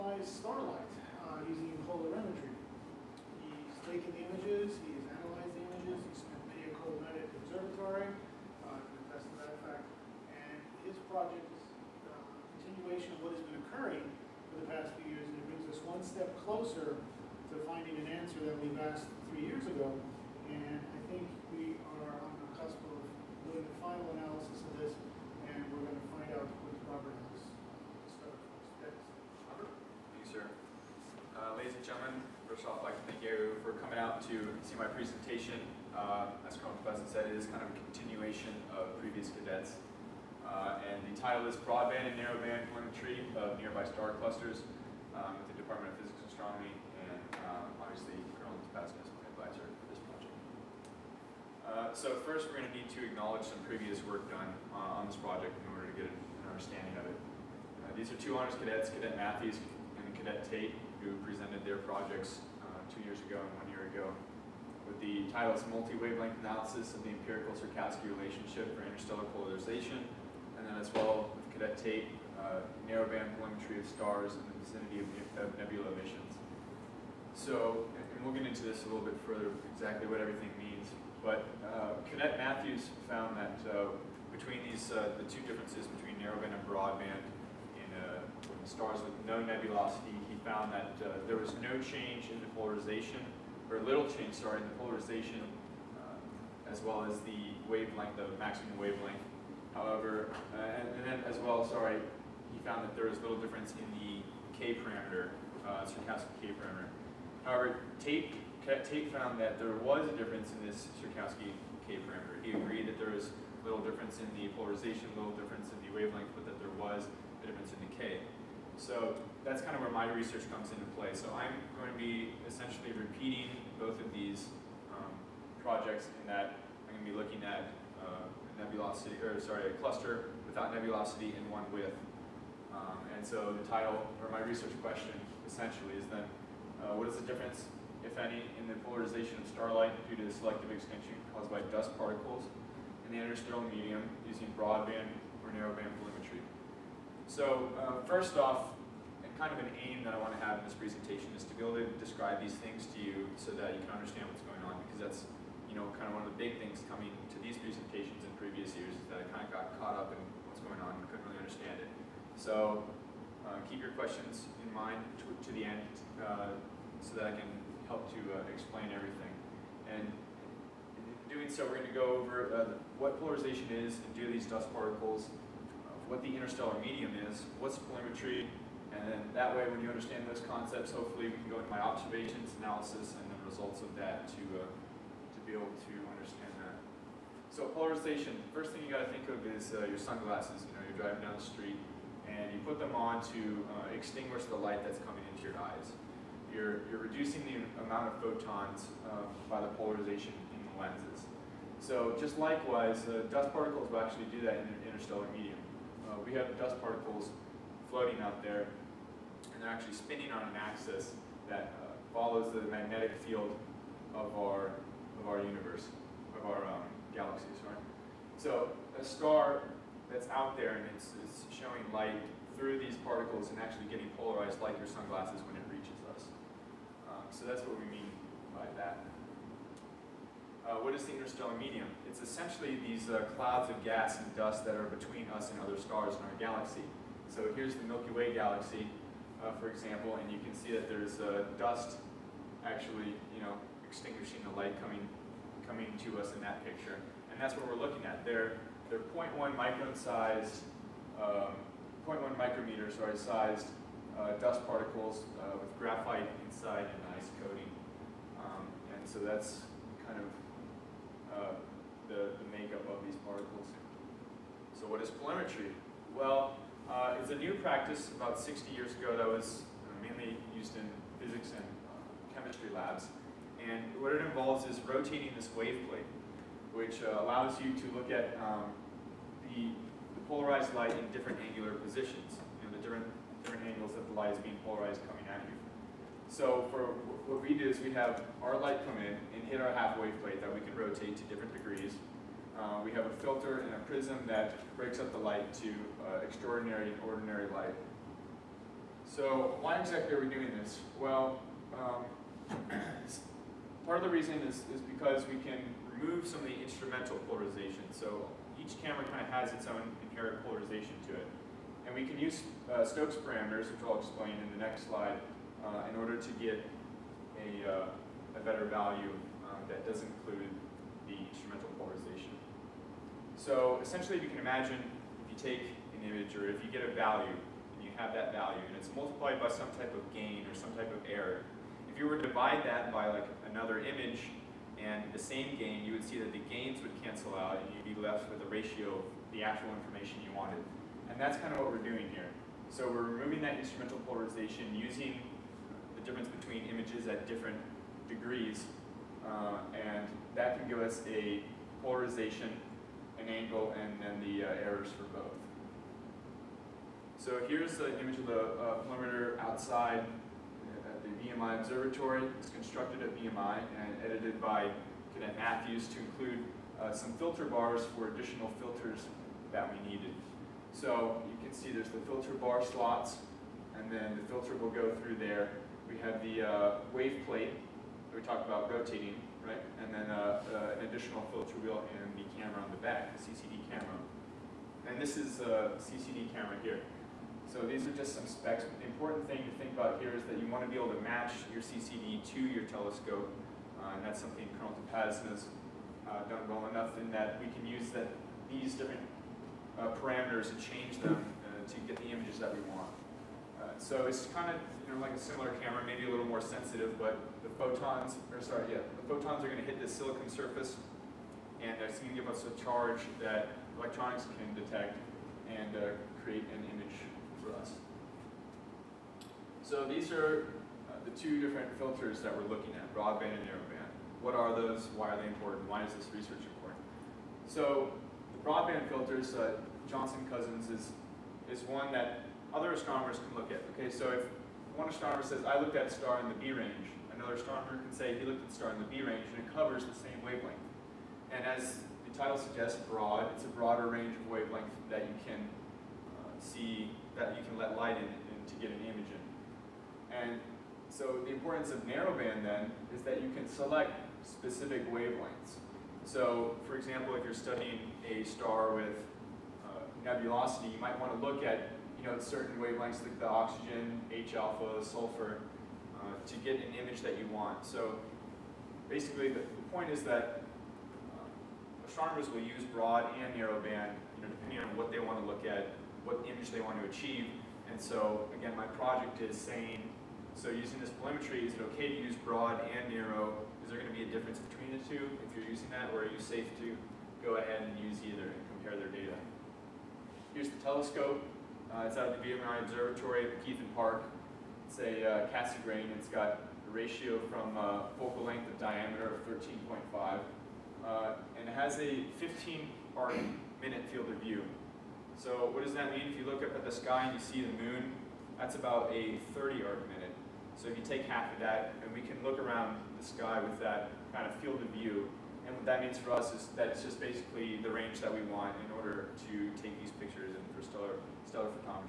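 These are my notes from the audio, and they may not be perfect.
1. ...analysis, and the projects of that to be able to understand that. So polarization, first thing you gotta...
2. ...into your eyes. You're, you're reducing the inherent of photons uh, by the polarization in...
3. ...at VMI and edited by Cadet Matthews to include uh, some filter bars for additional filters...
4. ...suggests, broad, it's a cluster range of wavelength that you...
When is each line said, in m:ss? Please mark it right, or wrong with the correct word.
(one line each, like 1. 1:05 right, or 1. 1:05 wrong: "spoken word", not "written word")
1. 3:02 wrong: "results", not "projects"
2. 3:15 wrong: "amount", not "inherent"
3. 6:03 right
4. 7:22 wrong: "broader", not "cluster".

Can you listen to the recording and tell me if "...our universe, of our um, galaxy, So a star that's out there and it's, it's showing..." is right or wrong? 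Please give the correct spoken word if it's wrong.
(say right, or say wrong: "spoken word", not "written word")
right.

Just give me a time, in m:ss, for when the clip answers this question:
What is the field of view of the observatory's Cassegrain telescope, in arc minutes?
8:22.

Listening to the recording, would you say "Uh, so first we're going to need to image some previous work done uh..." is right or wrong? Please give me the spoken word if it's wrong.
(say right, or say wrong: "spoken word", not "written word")
wrong: "acknowledge", not "image".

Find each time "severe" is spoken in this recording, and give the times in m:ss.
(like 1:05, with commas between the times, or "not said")
not said.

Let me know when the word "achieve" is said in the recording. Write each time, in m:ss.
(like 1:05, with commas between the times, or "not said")
7:56.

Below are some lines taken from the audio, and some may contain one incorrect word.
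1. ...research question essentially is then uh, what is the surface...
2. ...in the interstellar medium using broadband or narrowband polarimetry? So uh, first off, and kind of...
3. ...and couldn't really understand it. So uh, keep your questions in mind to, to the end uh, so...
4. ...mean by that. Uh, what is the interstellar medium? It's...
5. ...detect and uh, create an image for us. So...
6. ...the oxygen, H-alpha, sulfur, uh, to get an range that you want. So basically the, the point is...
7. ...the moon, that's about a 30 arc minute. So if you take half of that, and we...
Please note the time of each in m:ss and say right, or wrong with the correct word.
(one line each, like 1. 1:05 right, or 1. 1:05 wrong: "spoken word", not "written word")
1. 2:14 wrong: "difference", not "surface"
2. 2:23 right
3. 2:40 right
4. 3:47 right
5. 6:54 right
6. 7:43 wrong: "image", not "range"
7. 8:27 right.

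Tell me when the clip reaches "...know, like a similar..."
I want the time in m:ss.
6:44.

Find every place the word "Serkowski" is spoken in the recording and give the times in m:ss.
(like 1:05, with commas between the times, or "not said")
1:07, 1:45, 1:50.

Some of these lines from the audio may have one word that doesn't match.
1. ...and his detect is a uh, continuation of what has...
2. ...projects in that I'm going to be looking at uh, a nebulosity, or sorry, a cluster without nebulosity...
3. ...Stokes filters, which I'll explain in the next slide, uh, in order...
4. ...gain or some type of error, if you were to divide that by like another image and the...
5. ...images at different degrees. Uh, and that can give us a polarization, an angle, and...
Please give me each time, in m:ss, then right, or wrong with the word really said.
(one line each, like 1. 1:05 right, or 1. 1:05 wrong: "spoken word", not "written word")
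1. 0:10 wrong: "project", not "detect"
2. 2:05 right
3. 5:12 wrong: "parameters", not "filters"
4. 5:30 right
5. 5:46 right.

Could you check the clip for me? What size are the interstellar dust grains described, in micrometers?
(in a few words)
0.1 micron.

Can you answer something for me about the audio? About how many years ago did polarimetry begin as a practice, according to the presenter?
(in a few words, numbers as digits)
60 years.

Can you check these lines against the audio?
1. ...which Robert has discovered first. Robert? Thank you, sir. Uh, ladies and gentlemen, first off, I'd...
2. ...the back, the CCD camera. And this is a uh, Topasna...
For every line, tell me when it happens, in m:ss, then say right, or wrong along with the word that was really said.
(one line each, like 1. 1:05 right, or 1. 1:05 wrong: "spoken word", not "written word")
1. 0:26 right
2. 6:22 wrong: "CCD", not "Topasna".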